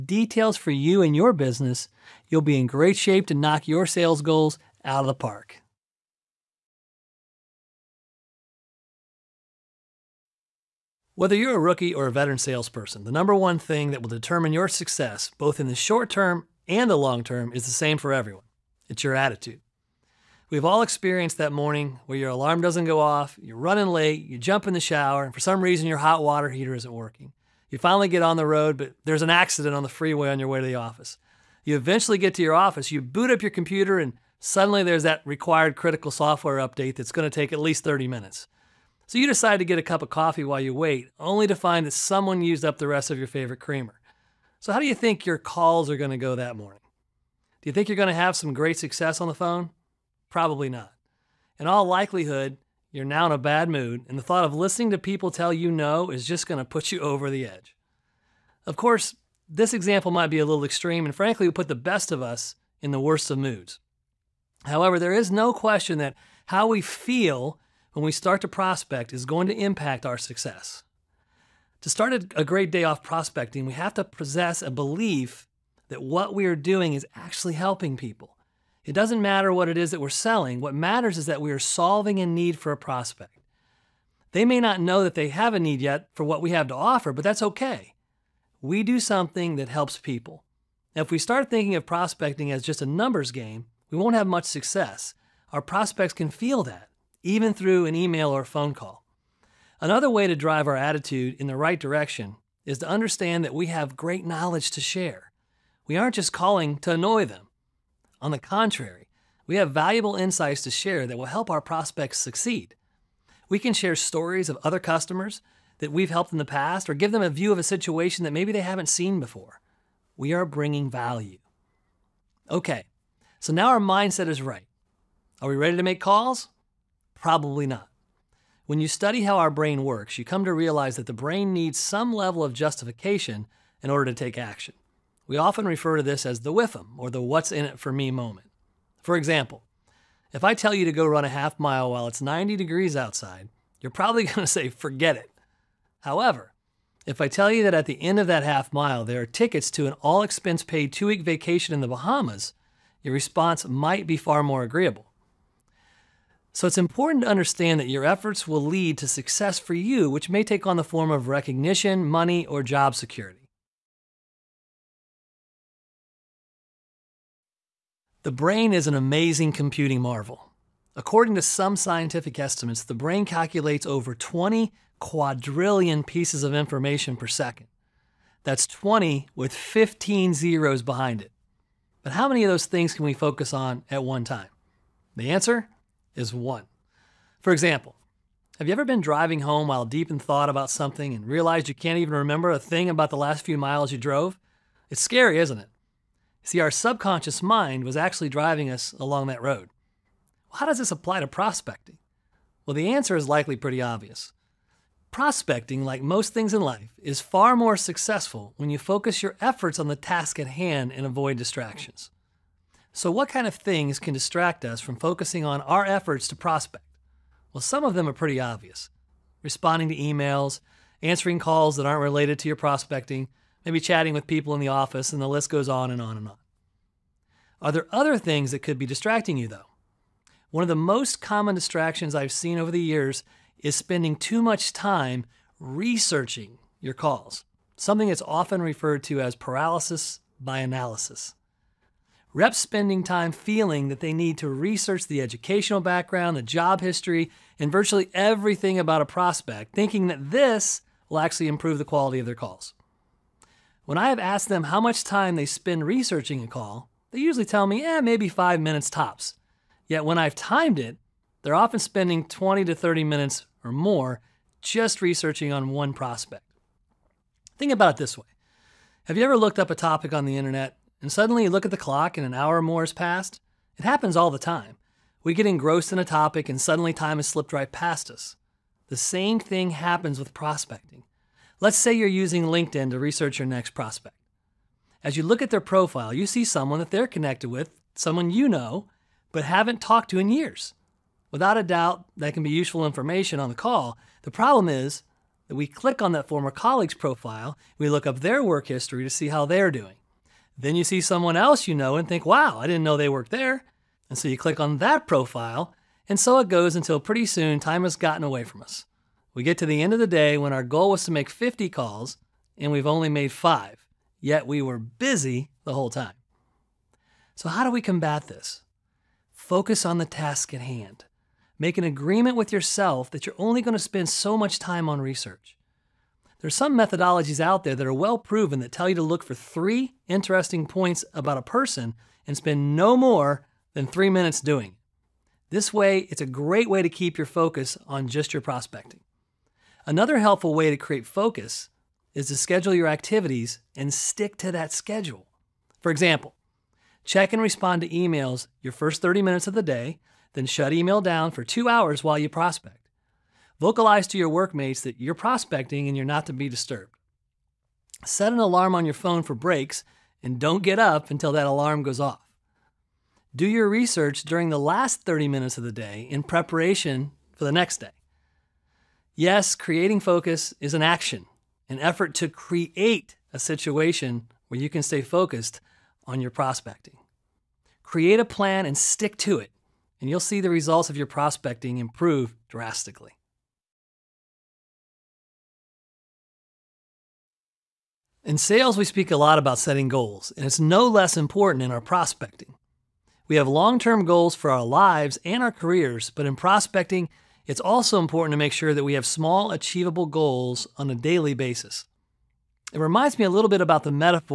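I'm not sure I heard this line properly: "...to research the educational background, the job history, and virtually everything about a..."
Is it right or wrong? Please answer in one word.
right.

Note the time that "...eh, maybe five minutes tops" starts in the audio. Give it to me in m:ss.
4:17.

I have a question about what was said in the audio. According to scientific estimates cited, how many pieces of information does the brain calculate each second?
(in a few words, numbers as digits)
20 quadrillion.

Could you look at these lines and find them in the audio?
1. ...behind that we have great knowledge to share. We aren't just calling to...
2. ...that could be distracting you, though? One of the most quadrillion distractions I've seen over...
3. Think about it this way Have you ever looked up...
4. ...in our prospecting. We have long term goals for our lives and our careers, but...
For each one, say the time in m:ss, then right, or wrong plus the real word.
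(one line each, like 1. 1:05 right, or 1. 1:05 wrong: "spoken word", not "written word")
1. 1:42 wrong: "understand", not "behind"
2. 3:48 wrong: "common", not "quadrillion"
3. 4:27 right
4. 6:31 right.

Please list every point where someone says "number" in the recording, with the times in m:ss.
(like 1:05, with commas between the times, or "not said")
0:13, 1:32.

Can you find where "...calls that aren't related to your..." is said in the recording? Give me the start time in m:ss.
3:41.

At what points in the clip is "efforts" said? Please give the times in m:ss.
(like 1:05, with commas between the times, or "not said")
2:38, 3:29, 3:35, 6:11.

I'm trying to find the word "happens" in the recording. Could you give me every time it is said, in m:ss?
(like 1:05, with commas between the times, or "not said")
4:33, 4:39.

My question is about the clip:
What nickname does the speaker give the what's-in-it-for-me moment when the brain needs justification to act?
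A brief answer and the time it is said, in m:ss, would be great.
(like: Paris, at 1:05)
whiffum, at 2:16.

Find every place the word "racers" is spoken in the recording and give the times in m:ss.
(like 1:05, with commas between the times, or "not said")
not said.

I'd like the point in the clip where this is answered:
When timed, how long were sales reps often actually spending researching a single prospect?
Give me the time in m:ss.
4:22.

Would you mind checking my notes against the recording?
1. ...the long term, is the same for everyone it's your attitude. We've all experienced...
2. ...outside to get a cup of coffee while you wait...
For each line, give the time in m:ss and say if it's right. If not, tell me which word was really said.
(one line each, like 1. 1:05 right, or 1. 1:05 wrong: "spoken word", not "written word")
1. 0:16 right
2. 0:39 wrong: "decide", not "outside".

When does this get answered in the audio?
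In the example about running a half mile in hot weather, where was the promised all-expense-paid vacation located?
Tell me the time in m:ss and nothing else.
2:31.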